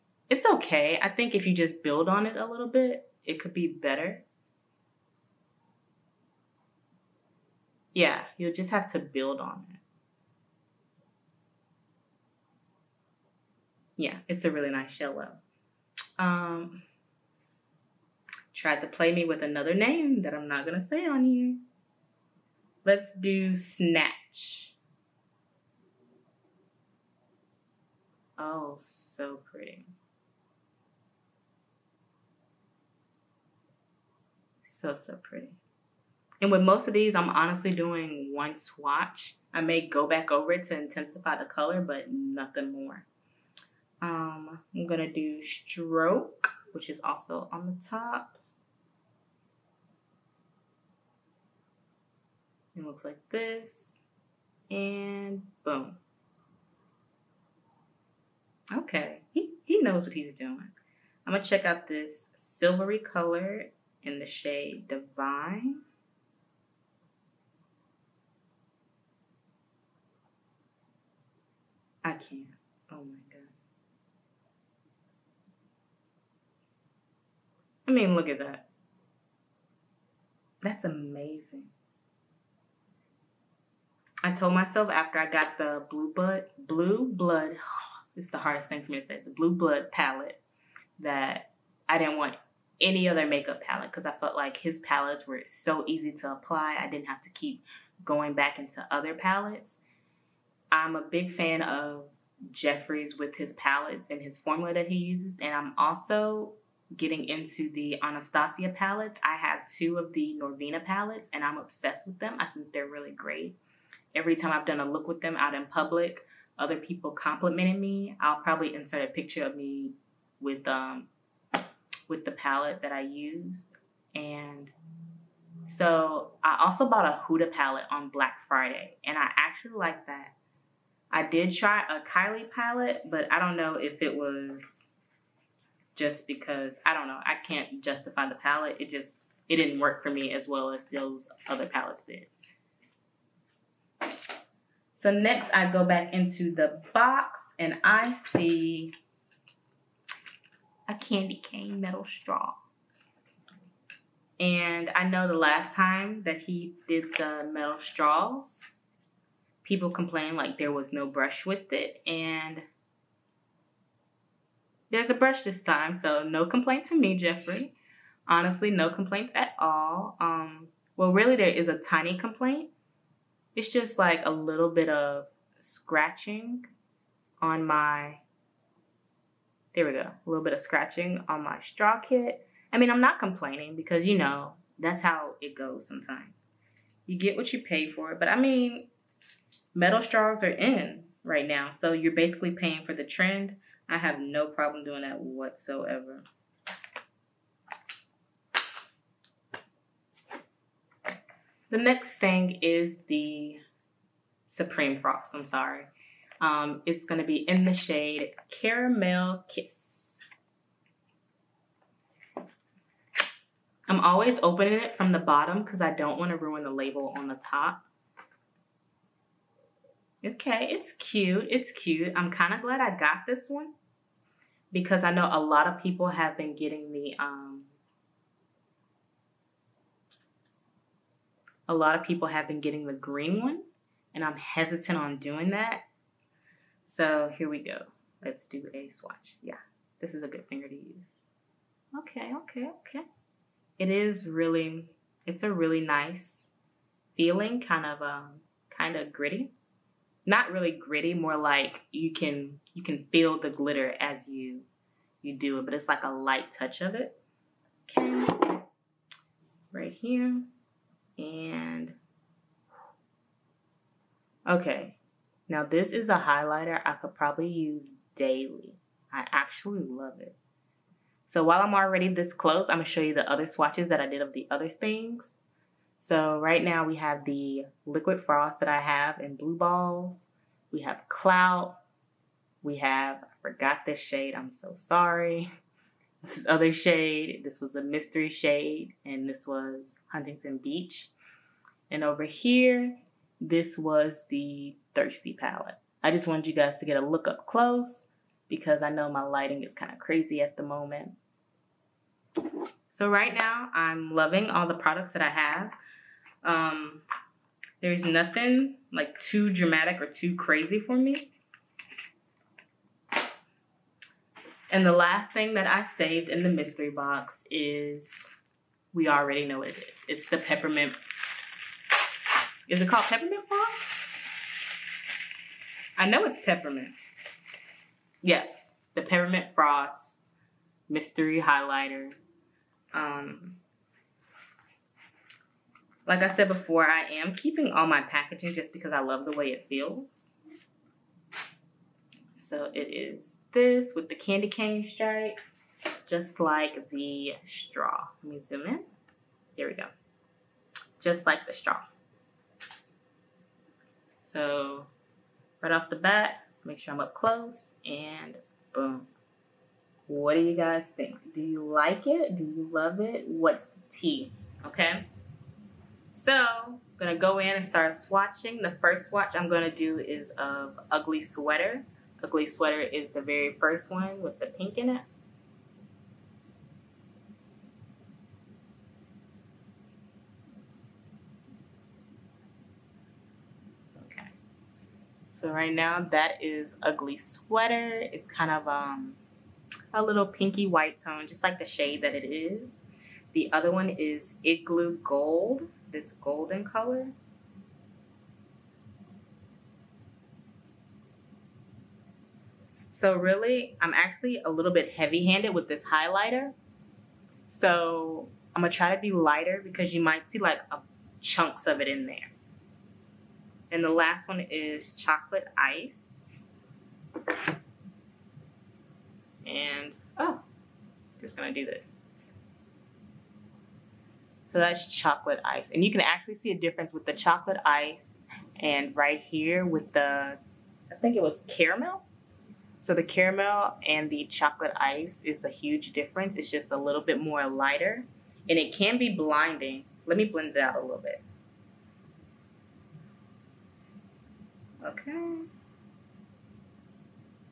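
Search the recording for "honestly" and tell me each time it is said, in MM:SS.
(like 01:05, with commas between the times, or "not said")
00:37, 02:48.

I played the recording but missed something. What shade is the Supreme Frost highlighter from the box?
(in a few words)
Caramel Kiss.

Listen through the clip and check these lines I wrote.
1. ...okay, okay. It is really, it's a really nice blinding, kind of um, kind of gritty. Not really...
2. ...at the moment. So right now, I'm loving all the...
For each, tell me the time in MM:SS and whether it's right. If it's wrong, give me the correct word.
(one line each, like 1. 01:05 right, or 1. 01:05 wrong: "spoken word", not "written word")
1. 04:02 wrong: "feeling", not "blinding"
2. 05:00 right.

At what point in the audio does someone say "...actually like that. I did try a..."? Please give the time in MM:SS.
02:09.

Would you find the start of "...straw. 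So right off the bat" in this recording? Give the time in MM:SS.
05:51.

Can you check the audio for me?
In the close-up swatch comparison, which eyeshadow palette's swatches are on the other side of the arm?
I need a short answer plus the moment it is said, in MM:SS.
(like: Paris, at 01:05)
Thirsty, at 04:54.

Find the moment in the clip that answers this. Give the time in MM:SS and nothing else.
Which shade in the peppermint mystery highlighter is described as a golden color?
06:34.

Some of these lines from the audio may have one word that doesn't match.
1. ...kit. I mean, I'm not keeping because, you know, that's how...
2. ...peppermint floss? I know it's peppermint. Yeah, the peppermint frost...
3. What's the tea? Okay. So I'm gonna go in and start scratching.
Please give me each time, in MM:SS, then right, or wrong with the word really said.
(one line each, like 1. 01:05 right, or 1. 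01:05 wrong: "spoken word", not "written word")
1. 03:01 wrong: "complaining", not "keeping"
2. 05:23 right
3. 06:03 wrong: "swatching", not "scratching".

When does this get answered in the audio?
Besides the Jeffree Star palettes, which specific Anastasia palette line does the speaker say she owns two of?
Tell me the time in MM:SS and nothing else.
01:50.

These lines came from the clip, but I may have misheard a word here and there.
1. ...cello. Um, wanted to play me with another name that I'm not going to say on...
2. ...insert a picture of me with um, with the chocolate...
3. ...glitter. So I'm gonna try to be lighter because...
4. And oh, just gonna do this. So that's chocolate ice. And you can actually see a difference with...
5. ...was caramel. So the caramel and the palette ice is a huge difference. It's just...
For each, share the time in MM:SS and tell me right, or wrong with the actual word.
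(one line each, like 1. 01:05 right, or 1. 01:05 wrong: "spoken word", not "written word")
1. 00:14 wrong: "tried", not "wanted"
2. 01:58 wrong: "palette", not "chocolate"
3. 06:45 wrong: "highlighter", not "glitter"
4. 06:59 right
5. 07:11 wrong: "chocolate", not "palette".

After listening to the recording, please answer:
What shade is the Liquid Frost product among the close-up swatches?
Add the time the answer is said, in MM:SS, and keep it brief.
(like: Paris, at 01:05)
Blue Balls, at 04:39.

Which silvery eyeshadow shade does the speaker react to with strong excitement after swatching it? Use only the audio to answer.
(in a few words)
Divine.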